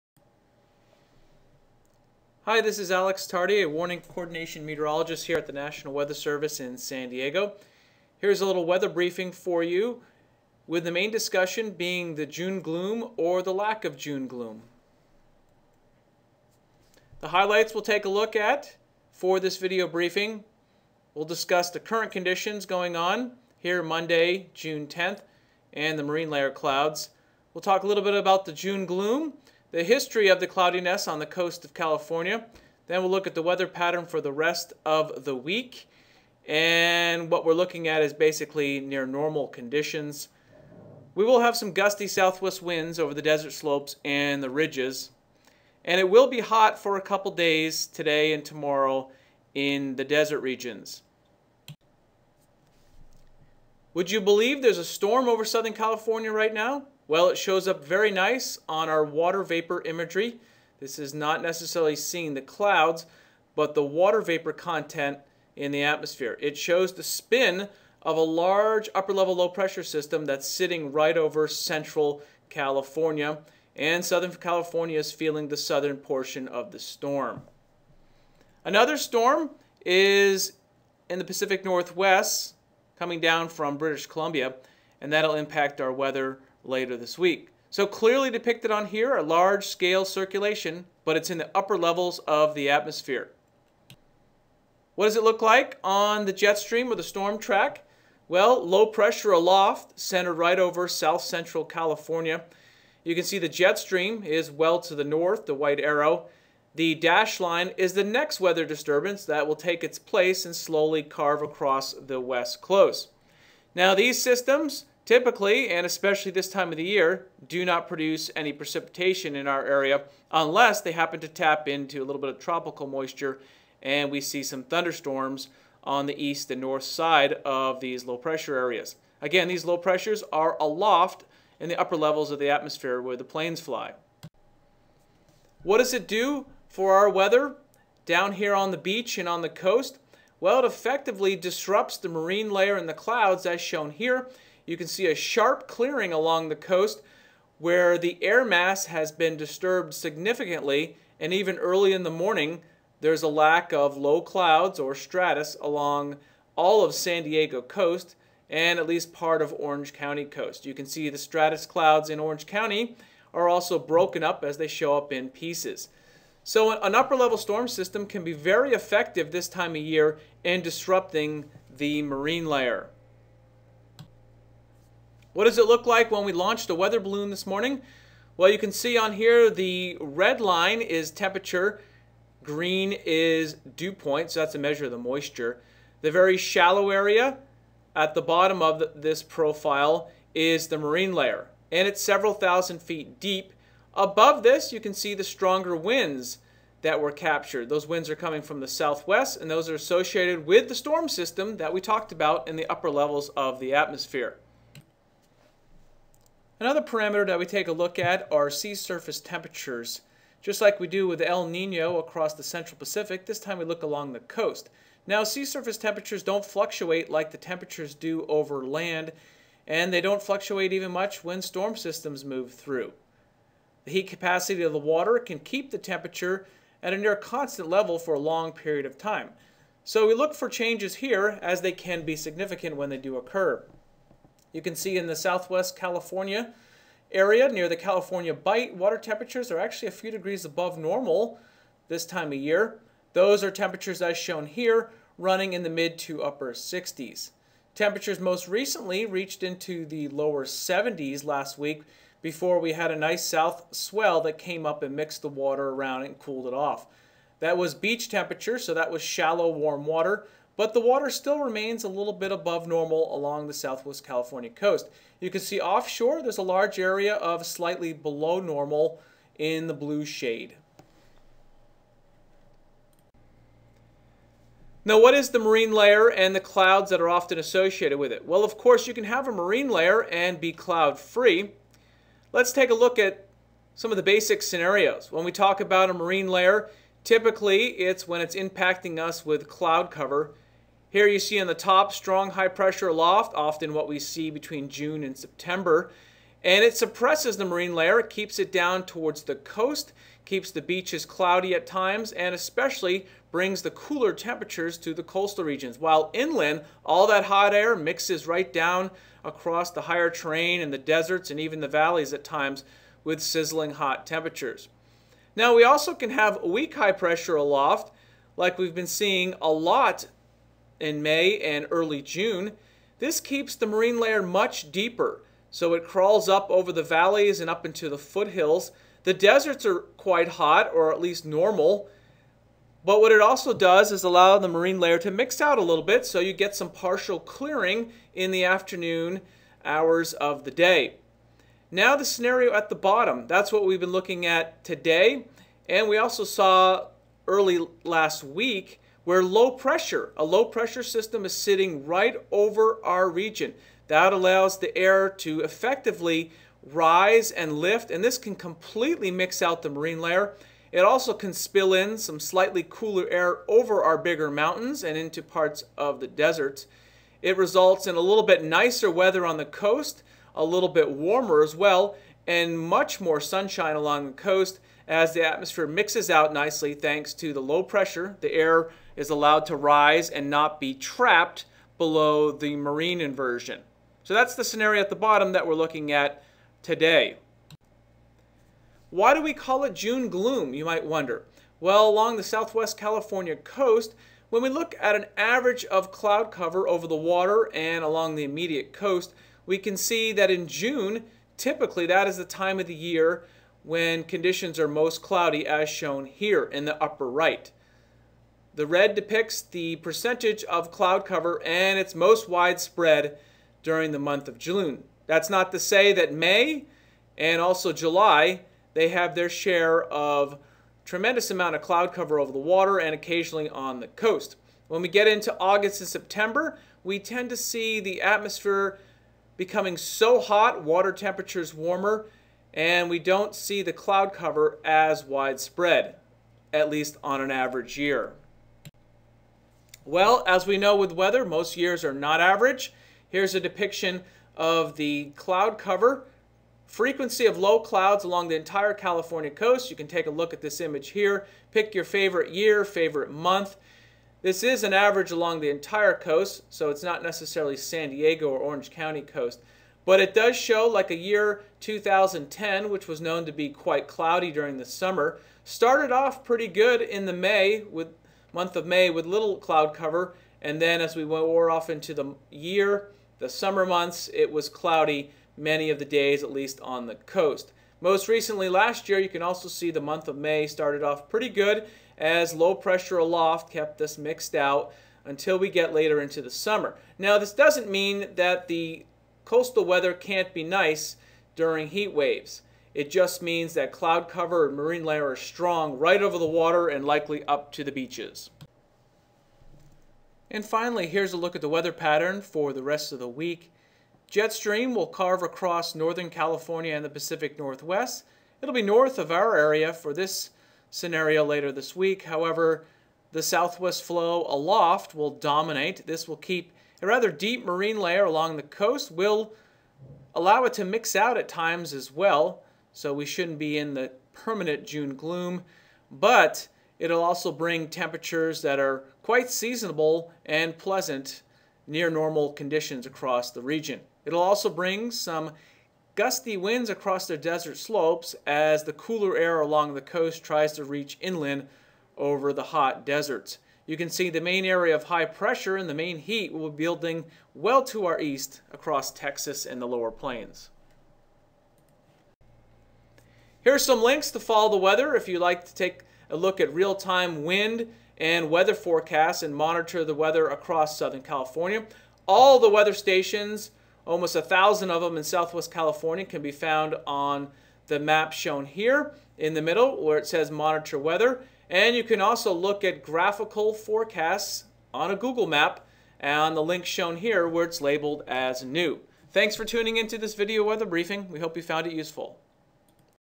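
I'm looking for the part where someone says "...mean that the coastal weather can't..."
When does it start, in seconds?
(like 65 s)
487 s.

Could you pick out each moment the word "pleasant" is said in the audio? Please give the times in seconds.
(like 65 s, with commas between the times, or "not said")
530 s.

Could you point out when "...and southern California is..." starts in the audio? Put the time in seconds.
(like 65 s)
73 s.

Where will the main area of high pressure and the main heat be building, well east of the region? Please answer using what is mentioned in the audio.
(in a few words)
Texas and the lower plains.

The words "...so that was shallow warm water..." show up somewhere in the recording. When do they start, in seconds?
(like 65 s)
258 s.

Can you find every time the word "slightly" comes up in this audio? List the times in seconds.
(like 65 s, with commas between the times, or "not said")
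267 s, 362 s.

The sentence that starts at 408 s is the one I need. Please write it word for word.
The red depicts the percentage of cloud cover and it's most widespread during the month of June.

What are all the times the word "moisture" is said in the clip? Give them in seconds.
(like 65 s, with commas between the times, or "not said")
122 s, 184 s.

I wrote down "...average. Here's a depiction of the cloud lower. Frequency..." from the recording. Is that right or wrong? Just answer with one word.
wrong.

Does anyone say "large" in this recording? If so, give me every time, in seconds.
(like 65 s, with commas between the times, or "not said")
68 s, 89 s, 266 s.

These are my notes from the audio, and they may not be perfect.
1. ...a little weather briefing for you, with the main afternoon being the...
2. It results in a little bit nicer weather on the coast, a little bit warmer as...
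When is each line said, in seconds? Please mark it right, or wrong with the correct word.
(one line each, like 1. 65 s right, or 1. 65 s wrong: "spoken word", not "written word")
1. 8 s wrong: "discussion", not "afternoon"
2. 367 s right.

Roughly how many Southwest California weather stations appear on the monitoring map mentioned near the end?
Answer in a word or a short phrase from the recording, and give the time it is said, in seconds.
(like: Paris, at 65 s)
Almost 1,000, at 563 s.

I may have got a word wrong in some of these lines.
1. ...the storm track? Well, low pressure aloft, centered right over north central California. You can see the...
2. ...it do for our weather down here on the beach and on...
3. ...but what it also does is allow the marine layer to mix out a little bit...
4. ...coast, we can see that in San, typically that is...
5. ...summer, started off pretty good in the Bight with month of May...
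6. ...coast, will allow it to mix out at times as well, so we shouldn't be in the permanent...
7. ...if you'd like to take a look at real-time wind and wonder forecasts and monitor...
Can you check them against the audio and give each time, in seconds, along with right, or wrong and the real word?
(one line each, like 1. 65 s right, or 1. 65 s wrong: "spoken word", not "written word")
1. 96 s wrong: "south", not "north"
2. 135 s right
3. 332 s right
4. 398 s wrong: "June", not "San"
5. 464 s wrong: "May", not "Bight"
6. 518 s right
7. 554 s wrong: "weather", not "wonder".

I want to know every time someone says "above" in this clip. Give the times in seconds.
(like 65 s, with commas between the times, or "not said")
193 s, 240 s, 262 s.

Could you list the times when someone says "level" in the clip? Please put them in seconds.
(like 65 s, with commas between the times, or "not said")
69 s, 91 s, 131 s, 167 s, 202 s, 227 s.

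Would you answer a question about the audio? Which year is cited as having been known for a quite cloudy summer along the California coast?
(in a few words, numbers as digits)
2010.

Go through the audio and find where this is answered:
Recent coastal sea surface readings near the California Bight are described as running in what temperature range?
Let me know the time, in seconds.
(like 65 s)
245 s.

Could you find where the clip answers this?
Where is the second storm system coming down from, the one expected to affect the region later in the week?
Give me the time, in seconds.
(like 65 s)
83 s.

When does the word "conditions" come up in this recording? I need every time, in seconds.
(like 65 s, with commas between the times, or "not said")
22 s, 39 s, 404 s, 532 s.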